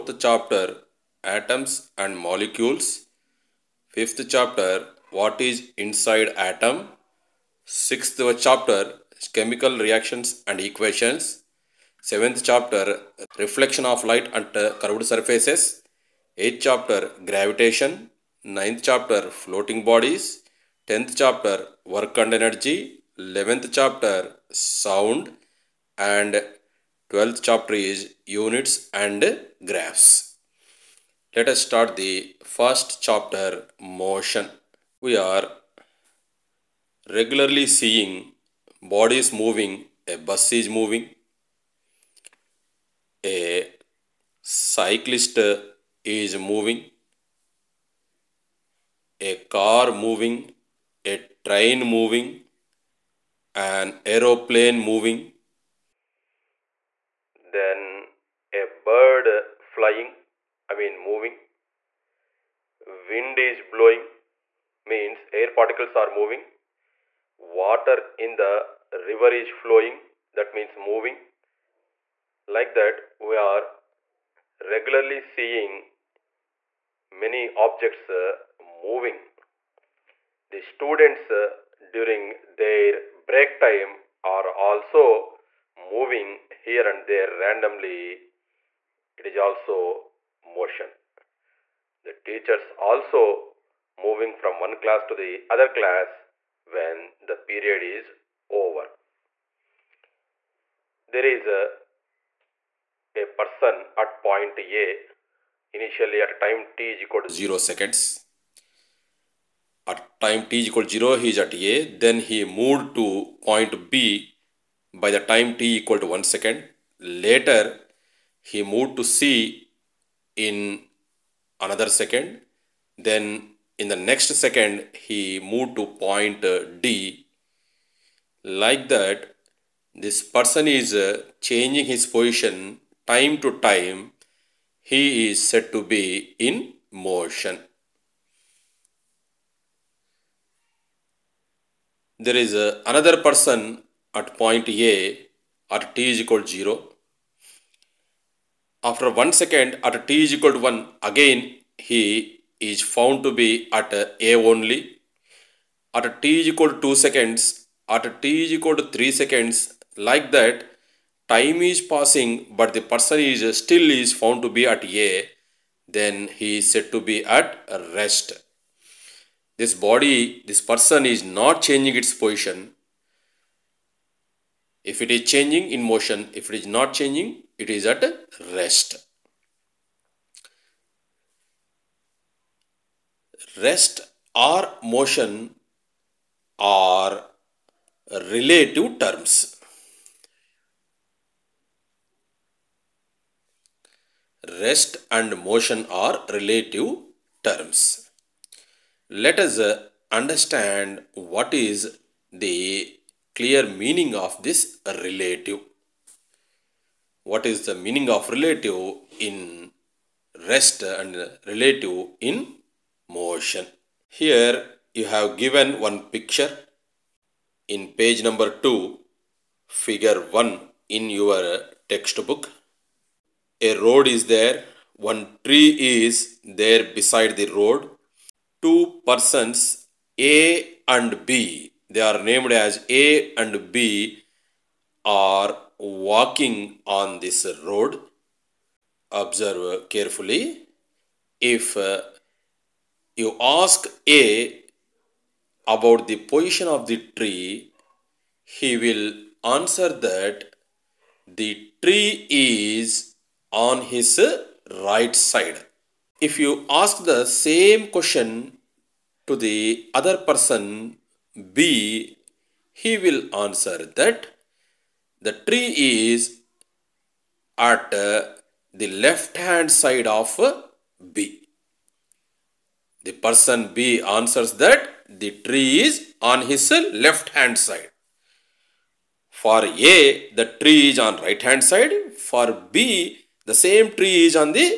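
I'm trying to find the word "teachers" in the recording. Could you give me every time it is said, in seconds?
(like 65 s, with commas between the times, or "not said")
92 s.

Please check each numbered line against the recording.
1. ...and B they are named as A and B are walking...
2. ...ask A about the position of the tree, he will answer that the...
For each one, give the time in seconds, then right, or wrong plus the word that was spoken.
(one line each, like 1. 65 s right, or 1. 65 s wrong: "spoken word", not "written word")
1. 230 s right
2. 243 s right.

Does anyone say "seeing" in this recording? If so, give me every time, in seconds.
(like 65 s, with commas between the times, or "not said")
37 s, 75 s.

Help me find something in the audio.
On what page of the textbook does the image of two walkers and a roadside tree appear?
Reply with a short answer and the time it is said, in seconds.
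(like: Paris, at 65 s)
2, at 217 s.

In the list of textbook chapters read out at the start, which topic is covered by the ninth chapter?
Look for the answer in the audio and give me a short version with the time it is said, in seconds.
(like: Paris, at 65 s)
Floating bodies, at 19 s.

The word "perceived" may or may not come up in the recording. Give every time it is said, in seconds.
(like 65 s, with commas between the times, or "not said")
not said.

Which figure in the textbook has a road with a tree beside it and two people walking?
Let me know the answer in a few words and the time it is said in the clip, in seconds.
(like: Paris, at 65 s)
Figure 1, at 219 s.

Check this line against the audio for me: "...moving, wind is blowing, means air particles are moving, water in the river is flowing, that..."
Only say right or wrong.
right.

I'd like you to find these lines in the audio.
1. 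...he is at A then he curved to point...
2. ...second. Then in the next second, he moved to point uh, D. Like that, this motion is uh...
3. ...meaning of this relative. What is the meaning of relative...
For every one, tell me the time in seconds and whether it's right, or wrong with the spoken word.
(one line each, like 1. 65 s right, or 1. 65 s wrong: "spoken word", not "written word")
1. 111 s wrong: "moved", not "curved"
2. 121 s wrong: "person", not "motion"
3. 203 s right.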